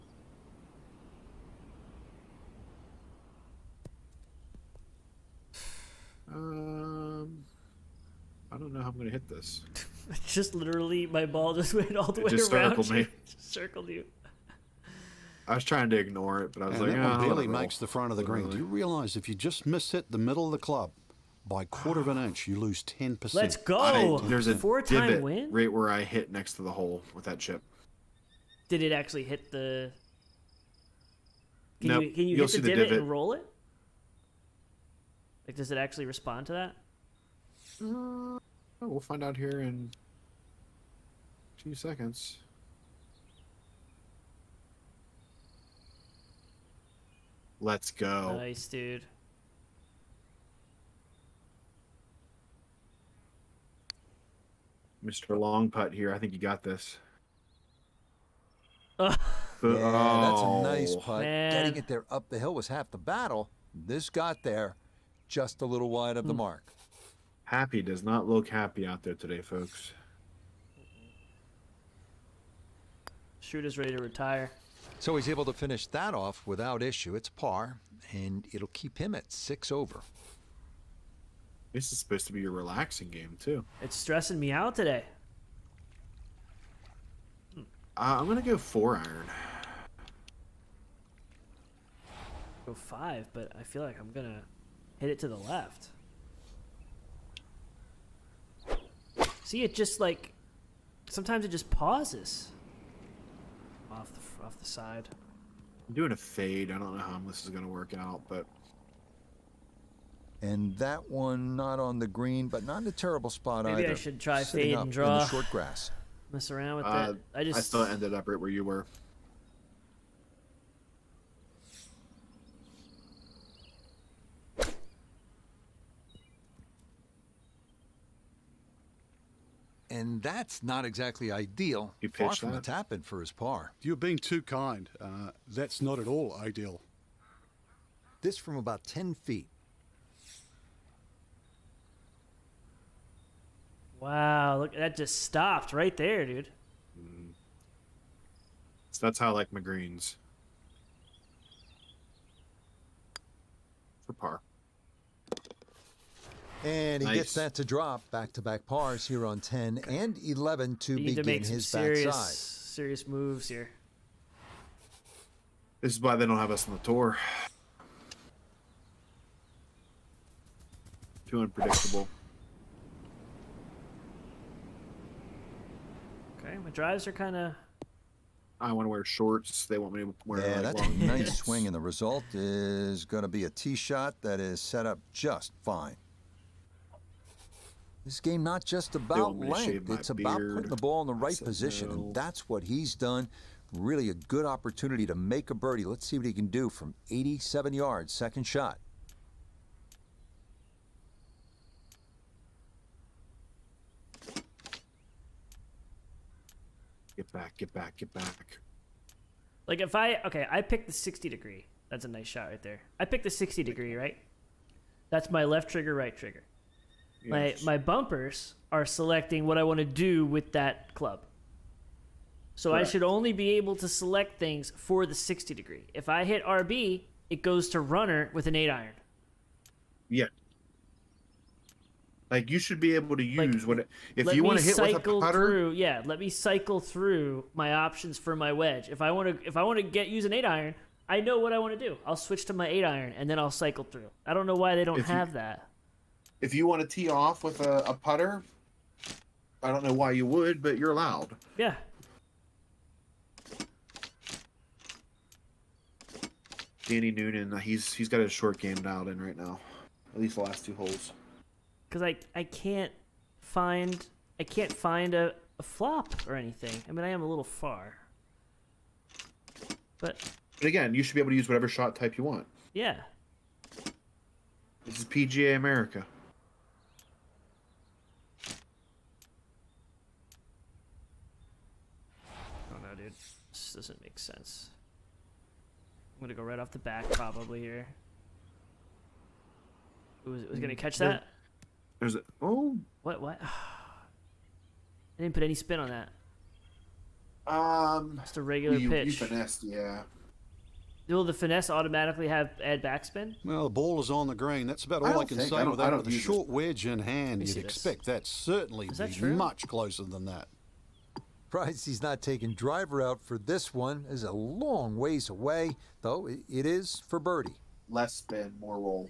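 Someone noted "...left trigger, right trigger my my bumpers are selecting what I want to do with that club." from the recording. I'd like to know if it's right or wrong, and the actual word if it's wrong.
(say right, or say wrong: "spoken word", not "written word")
right.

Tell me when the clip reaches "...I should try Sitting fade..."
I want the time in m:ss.
1:53.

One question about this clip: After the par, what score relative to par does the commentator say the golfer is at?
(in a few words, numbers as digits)
6 over.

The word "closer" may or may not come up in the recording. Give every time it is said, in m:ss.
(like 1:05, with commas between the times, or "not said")
5:09.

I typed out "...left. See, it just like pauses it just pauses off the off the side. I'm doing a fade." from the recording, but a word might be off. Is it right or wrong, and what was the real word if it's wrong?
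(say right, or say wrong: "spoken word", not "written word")
wrong: "sometimes", not "pauses".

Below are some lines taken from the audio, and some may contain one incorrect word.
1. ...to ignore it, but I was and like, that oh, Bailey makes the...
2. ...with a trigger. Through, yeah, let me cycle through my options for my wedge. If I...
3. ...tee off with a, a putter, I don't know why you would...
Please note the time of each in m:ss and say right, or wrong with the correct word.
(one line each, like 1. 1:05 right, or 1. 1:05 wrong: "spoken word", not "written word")
1. 0:15 right
2. 3:54 wrong: "putter", not "trigger"
3. 4:06 right.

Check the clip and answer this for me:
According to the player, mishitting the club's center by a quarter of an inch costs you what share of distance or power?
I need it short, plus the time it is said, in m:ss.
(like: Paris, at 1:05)
10 percent, at 0:22.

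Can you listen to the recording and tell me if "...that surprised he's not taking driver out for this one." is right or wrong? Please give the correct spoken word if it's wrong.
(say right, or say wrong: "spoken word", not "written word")
right.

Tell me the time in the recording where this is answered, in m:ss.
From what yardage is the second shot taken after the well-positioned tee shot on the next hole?
3:17.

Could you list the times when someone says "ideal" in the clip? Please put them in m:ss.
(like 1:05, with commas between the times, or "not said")
2:11, 2:16.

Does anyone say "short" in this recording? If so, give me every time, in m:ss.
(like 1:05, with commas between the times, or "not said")
1:55, 2:59, 4:18, 5:06.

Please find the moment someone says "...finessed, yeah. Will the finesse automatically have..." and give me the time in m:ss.
4:59.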